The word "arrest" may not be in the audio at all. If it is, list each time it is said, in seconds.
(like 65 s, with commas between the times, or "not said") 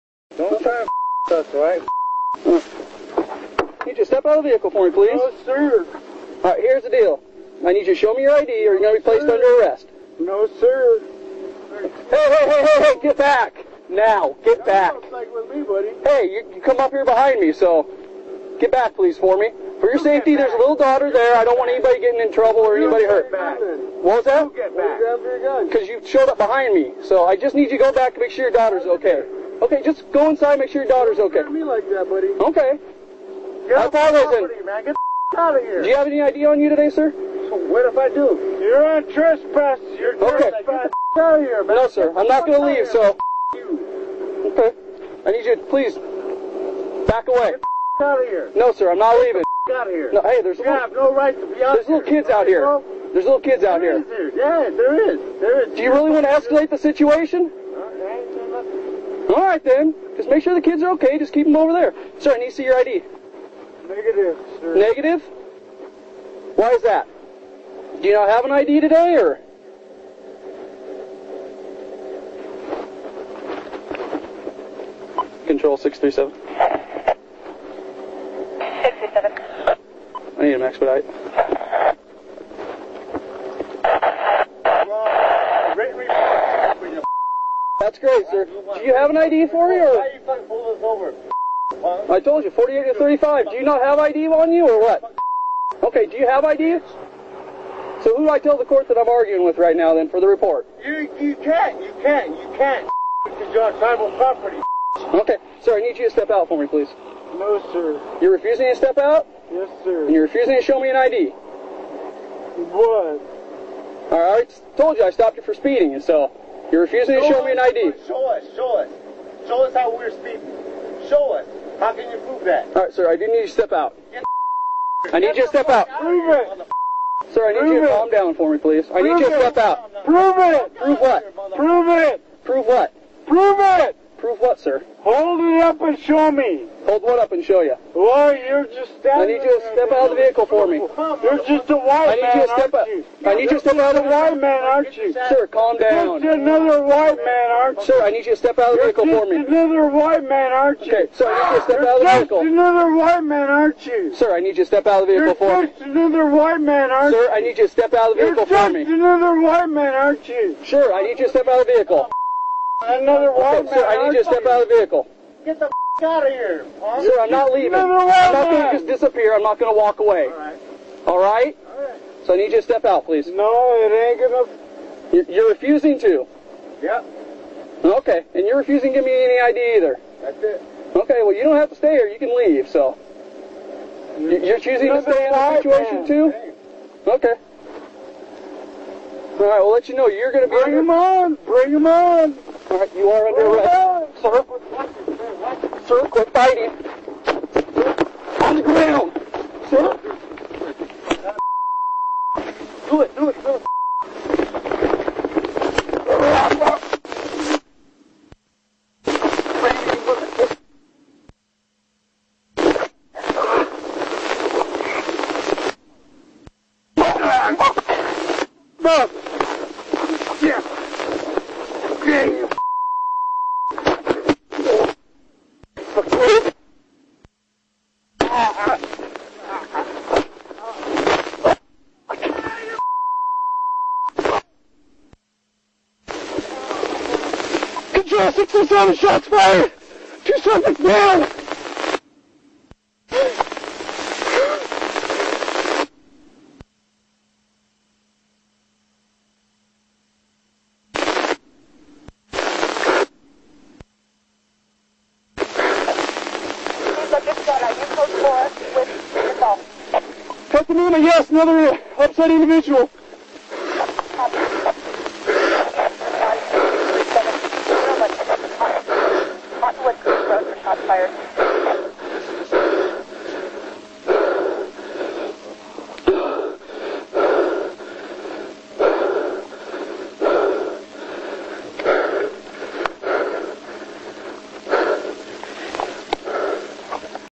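9 s, 194 s.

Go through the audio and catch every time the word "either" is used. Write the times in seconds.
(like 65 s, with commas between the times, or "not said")
179 s.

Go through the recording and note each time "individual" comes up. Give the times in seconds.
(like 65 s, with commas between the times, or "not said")
262 s.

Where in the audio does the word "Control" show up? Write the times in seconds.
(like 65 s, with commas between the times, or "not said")
75 s, 234 s.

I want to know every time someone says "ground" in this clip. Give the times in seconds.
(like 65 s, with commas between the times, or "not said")
198 s.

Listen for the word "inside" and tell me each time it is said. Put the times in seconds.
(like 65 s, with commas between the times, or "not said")
30 s.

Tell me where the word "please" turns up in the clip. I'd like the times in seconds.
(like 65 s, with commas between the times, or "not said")
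4 s, 18 s, 45 s, 106 s, 128 s, 173 s.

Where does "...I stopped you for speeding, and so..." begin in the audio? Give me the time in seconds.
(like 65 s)
115 s.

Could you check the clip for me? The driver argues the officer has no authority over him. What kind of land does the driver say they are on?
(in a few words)
tribal property.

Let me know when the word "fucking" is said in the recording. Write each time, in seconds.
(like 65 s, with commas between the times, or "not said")
90 s.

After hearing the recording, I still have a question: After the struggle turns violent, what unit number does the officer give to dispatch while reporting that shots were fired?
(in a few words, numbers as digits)
607.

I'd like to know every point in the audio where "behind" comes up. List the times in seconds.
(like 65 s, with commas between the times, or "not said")
17 s, 26 s.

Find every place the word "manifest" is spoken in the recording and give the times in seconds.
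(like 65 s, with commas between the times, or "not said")
not said.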